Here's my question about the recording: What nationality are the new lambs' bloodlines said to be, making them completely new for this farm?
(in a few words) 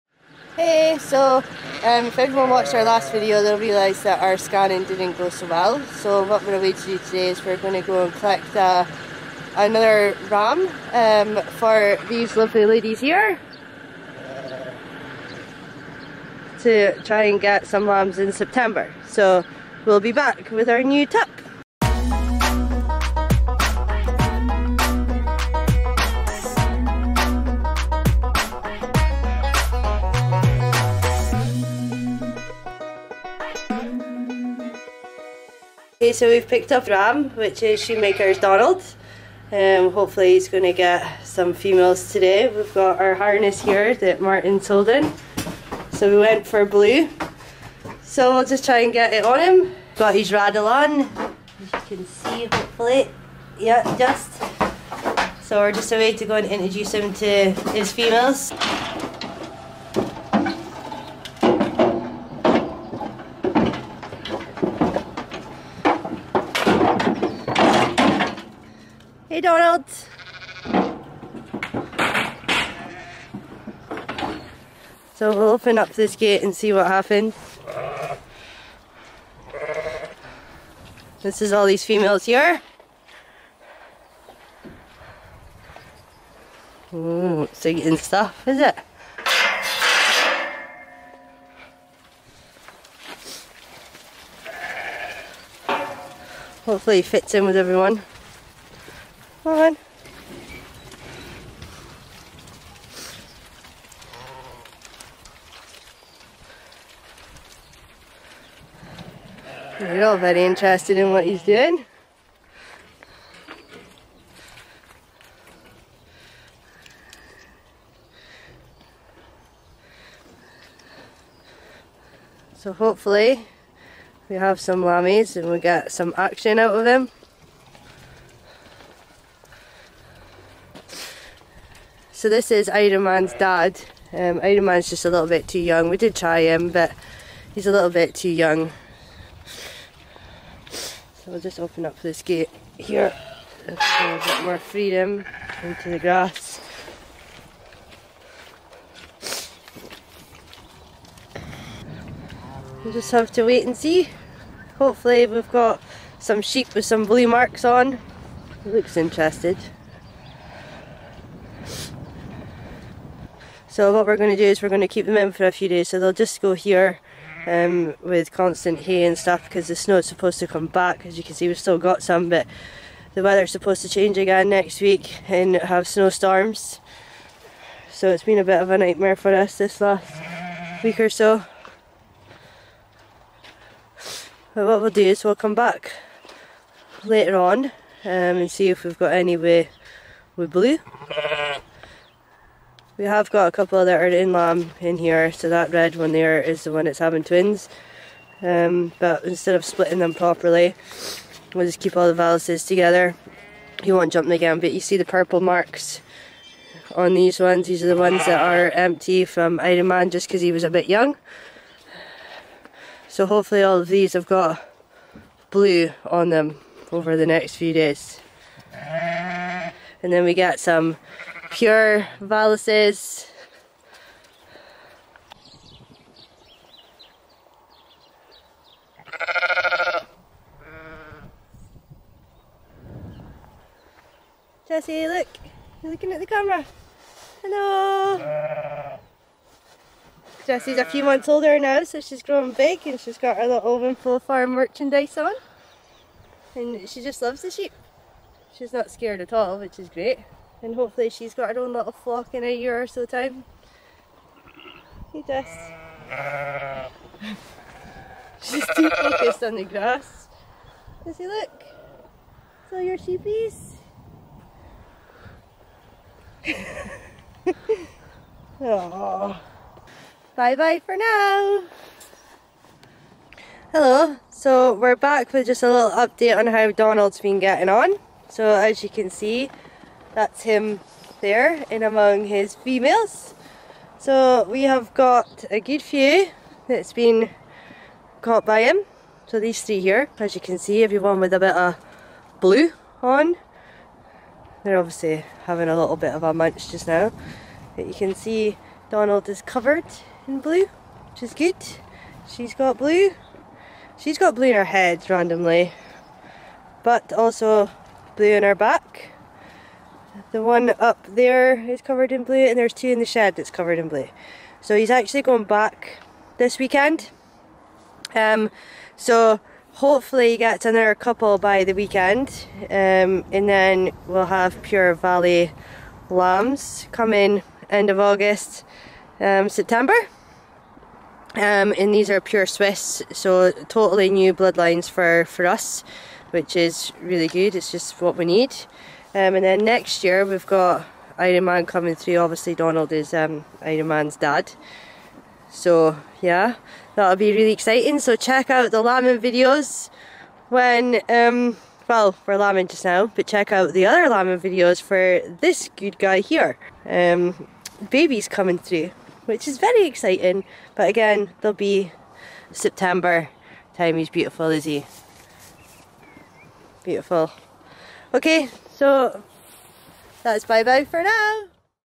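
Swiss.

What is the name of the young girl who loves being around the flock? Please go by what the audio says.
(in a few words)
Jessie.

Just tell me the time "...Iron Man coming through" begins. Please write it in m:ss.
5:41.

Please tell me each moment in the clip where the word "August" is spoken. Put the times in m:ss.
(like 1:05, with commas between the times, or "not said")
5:28.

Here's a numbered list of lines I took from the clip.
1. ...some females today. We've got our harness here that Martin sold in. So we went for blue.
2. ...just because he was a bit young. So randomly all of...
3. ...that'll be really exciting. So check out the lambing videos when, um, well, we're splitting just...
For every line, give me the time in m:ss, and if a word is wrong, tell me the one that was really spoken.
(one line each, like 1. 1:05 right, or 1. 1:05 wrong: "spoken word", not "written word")
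1. 0:41 right
2. 3:30 wrong: "hopefully", not "randomly"
3. 5:46 wrong: "lambing", not "splitting".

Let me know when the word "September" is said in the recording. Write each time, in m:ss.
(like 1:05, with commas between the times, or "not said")
0:18, 5:29, 6:02.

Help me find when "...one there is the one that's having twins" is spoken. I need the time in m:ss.
3:15.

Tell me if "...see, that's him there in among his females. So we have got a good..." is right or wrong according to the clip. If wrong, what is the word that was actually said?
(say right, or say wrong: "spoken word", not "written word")
right.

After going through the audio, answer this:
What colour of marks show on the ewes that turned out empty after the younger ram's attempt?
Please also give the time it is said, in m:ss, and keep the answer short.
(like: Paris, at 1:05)
Purple, at 3:25.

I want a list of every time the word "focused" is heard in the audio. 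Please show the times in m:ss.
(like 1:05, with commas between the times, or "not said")
4:18.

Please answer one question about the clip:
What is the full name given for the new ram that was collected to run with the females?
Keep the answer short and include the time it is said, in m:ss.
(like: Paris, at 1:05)
Shoemaker's Donald, at 0:37.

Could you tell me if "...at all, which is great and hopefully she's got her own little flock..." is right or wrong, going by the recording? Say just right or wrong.
right.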